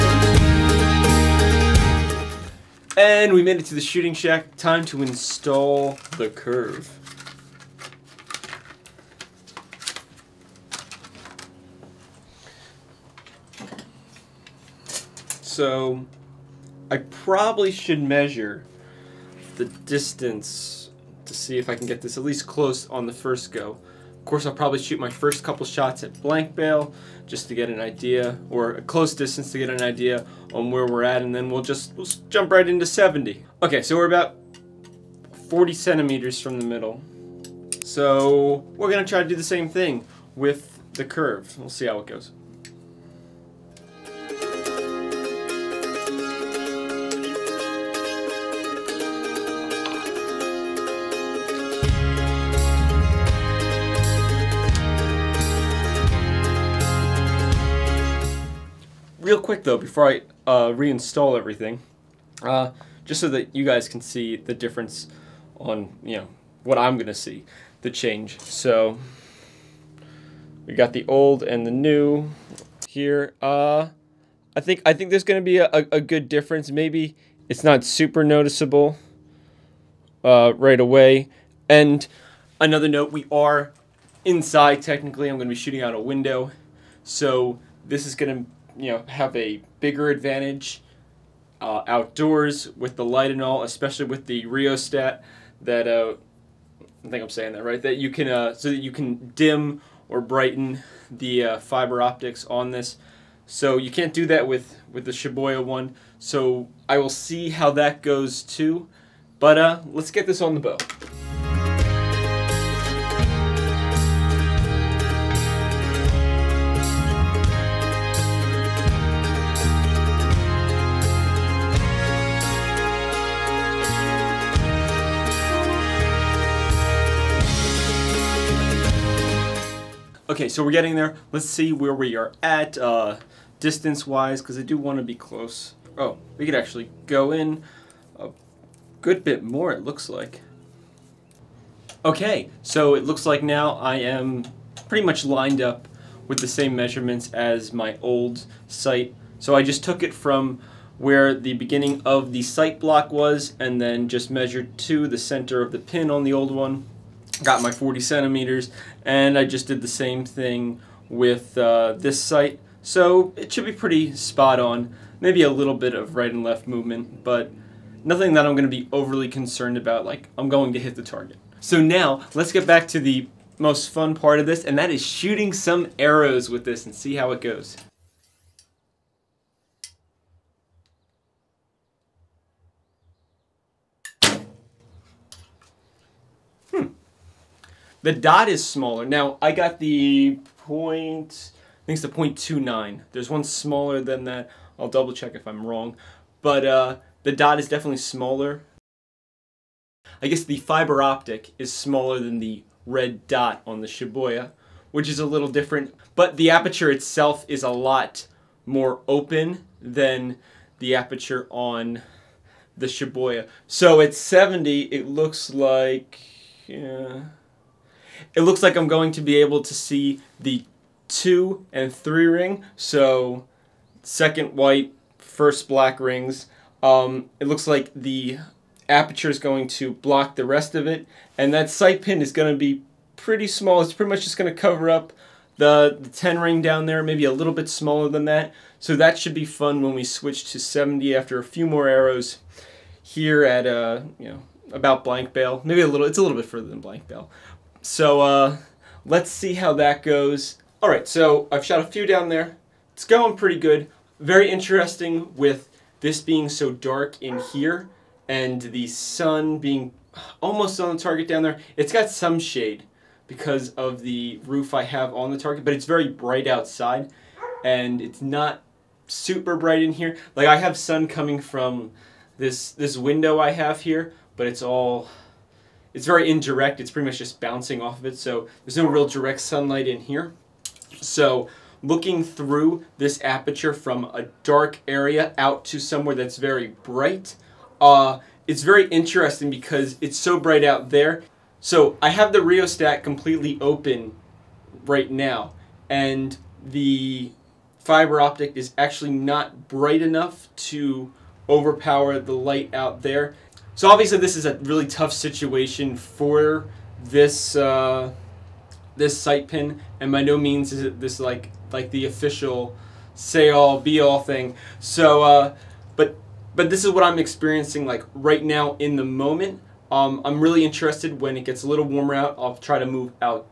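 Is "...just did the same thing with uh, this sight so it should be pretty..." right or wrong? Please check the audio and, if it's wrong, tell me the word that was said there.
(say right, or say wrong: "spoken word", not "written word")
right.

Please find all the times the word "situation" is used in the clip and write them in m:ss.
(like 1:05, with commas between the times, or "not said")
5:05.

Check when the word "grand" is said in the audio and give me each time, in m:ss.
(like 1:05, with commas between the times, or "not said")
not said.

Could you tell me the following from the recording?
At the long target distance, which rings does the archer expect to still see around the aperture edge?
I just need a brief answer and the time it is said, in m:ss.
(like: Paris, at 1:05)
two and three ring, at 3:41.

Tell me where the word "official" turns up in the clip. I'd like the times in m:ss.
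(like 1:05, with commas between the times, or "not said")
5:12.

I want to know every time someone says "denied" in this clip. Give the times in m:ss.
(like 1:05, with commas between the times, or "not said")
not said.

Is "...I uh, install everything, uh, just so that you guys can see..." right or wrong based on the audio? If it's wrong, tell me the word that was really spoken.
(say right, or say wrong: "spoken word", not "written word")
wrong: "reinstall", not "install".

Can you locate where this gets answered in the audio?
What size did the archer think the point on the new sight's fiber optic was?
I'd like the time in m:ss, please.
3:12.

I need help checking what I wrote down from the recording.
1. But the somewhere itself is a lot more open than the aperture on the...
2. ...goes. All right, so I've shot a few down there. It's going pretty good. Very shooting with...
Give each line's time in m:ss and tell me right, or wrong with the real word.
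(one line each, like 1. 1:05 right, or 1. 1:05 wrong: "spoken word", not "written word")
1. 3:26 wrong: "aperture", not "somewhere"
2. 4:10 wrong: "interesting", not "shooting".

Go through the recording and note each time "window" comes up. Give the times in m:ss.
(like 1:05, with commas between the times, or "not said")
1:26, 4:32.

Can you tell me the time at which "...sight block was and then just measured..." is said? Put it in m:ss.
2:32.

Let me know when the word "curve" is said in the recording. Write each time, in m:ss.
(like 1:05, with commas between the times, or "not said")
0:06, 0:41.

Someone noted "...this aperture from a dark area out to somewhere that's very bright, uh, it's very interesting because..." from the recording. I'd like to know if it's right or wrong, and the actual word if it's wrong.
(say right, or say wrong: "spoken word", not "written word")
right.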